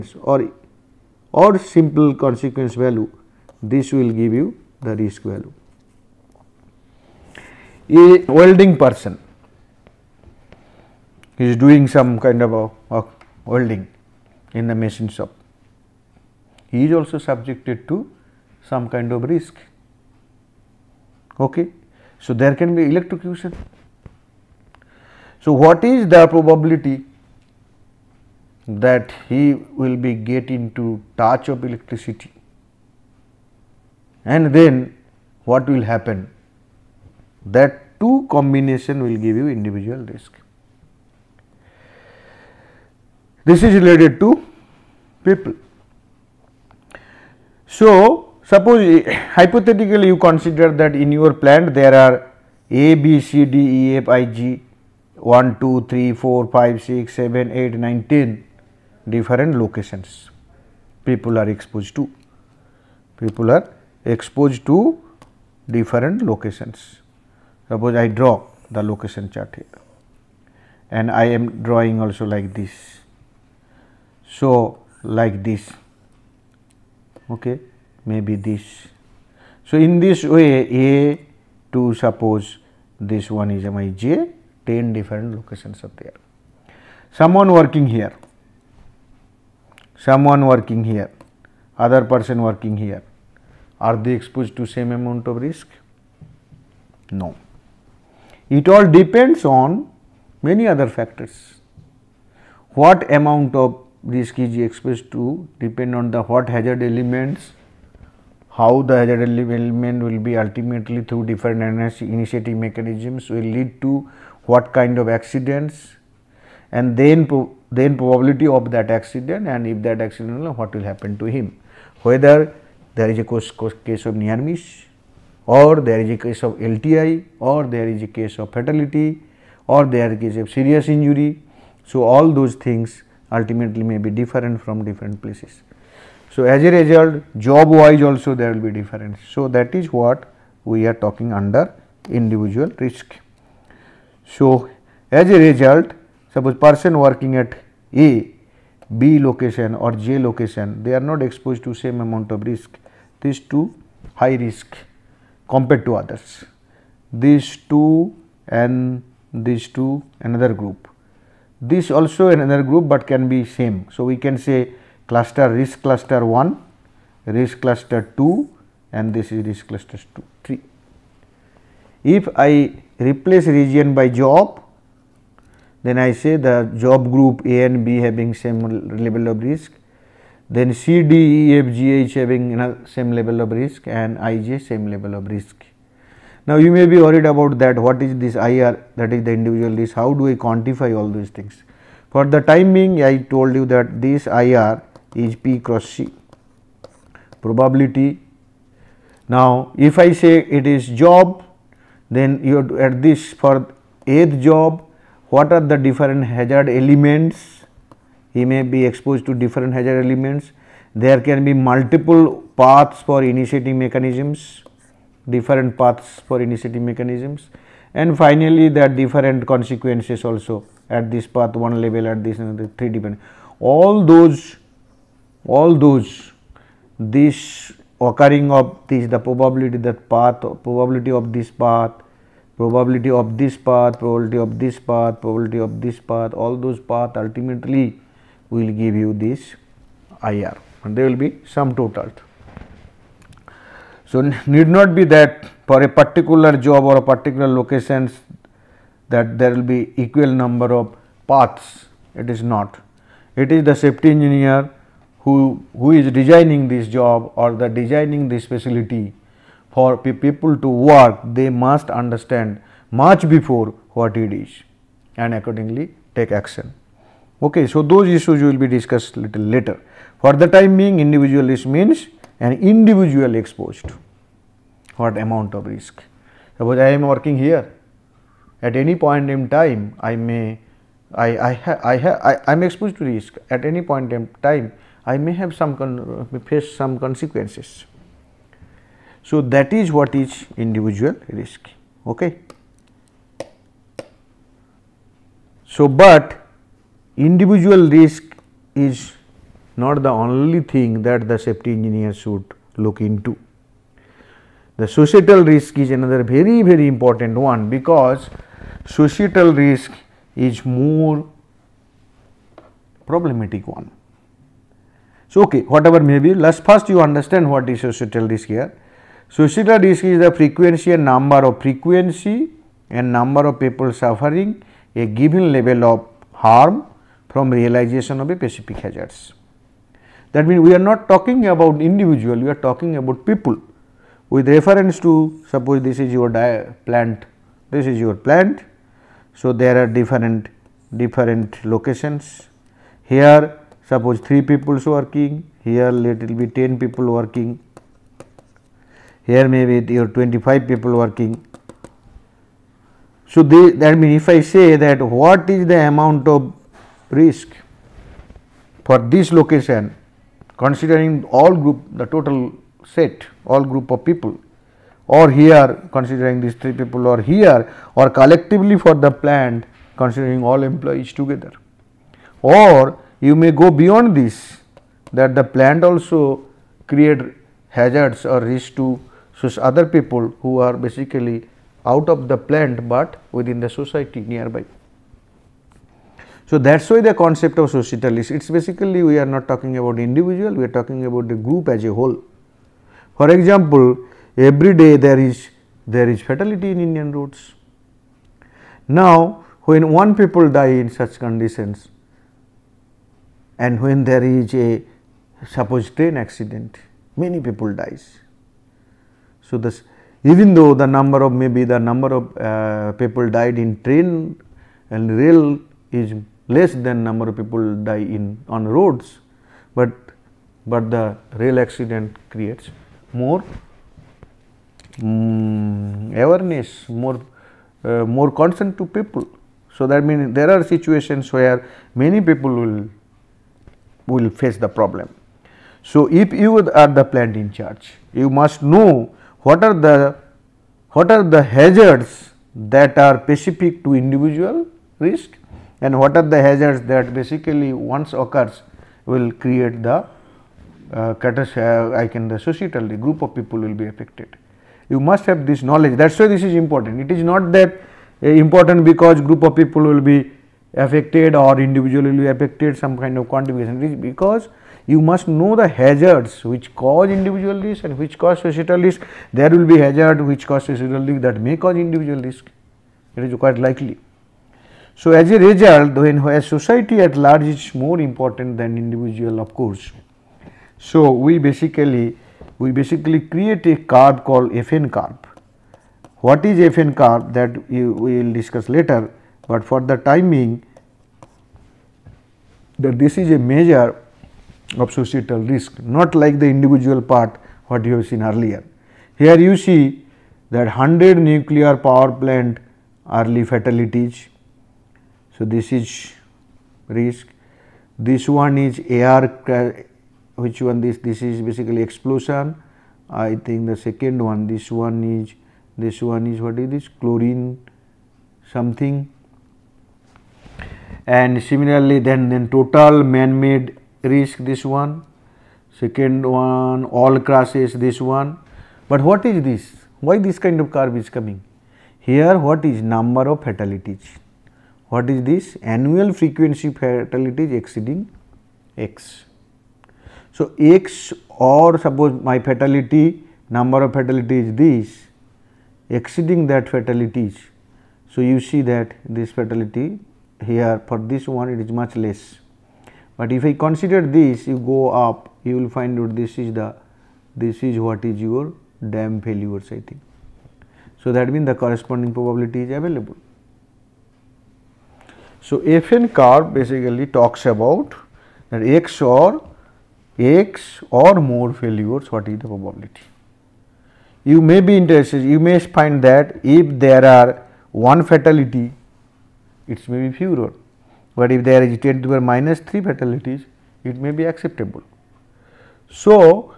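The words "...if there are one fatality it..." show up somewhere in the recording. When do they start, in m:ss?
9:36.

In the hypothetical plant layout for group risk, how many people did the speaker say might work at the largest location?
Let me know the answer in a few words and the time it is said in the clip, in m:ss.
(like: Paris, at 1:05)
25, at 5:50.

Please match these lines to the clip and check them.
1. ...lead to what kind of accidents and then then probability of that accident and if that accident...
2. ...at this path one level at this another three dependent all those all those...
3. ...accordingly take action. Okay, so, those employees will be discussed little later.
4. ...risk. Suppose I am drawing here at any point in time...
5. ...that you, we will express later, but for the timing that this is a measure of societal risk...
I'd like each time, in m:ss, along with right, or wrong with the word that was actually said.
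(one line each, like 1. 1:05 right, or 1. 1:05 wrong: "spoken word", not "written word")
1. 1:53 right
2. 3:40 right
3. 4:25 wrong: "issues", not "employees"
4. 4:35 wrong: "working", not "drawing"
5. 8:07 wrong: "discuss", not "express".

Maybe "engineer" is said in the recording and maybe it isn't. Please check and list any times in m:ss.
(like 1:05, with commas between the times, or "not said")
4:14, 5:01.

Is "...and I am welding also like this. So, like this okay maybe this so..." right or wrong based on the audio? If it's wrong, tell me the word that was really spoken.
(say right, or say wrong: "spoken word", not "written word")
wrong: "drawing", not "welding".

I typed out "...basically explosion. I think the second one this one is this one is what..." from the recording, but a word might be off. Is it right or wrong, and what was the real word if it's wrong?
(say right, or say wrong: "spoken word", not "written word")
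right.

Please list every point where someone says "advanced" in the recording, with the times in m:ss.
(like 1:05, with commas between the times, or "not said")
not said.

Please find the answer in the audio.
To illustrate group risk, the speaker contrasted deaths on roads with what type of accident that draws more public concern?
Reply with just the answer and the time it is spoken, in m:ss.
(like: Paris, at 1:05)
Train accident, at 6:45.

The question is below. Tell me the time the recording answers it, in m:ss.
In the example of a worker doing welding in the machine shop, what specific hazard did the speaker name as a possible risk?
0:22.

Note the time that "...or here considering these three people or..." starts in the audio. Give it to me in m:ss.
6:05.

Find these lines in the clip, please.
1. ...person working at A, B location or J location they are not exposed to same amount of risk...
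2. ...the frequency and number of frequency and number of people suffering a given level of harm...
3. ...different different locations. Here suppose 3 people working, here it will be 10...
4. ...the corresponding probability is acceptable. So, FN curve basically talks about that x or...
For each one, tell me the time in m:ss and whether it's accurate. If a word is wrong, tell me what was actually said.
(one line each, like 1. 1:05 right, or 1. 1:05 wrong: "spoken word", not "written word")
1. 2:26 right
2. 5:20 right
3. 5:39 right
4. 9:21 wrong: "available", not "acceptable".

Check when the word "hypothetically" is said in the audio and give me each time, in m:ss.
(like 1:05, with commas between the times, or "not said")
0:49.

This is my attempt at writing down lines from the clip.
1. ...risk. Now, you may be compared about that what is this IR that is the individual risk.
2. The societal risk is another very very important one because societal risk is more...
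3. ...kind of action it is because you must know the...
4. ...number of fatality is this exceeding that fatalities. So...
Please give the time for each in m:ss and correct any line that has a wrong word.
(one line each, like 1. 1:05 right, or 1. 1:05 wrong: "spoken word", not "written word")
1. 3:05 wrong: "worried", not "compared"
2. 5:04 right
3. 7:43 wrong: "contribution", not "action"
4. 9:03 right.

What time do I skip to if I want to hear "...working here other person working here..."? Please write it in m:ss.
1:30.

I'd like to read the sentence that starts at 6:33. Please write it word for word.
For example, every day there is there is fatality in Indian roads.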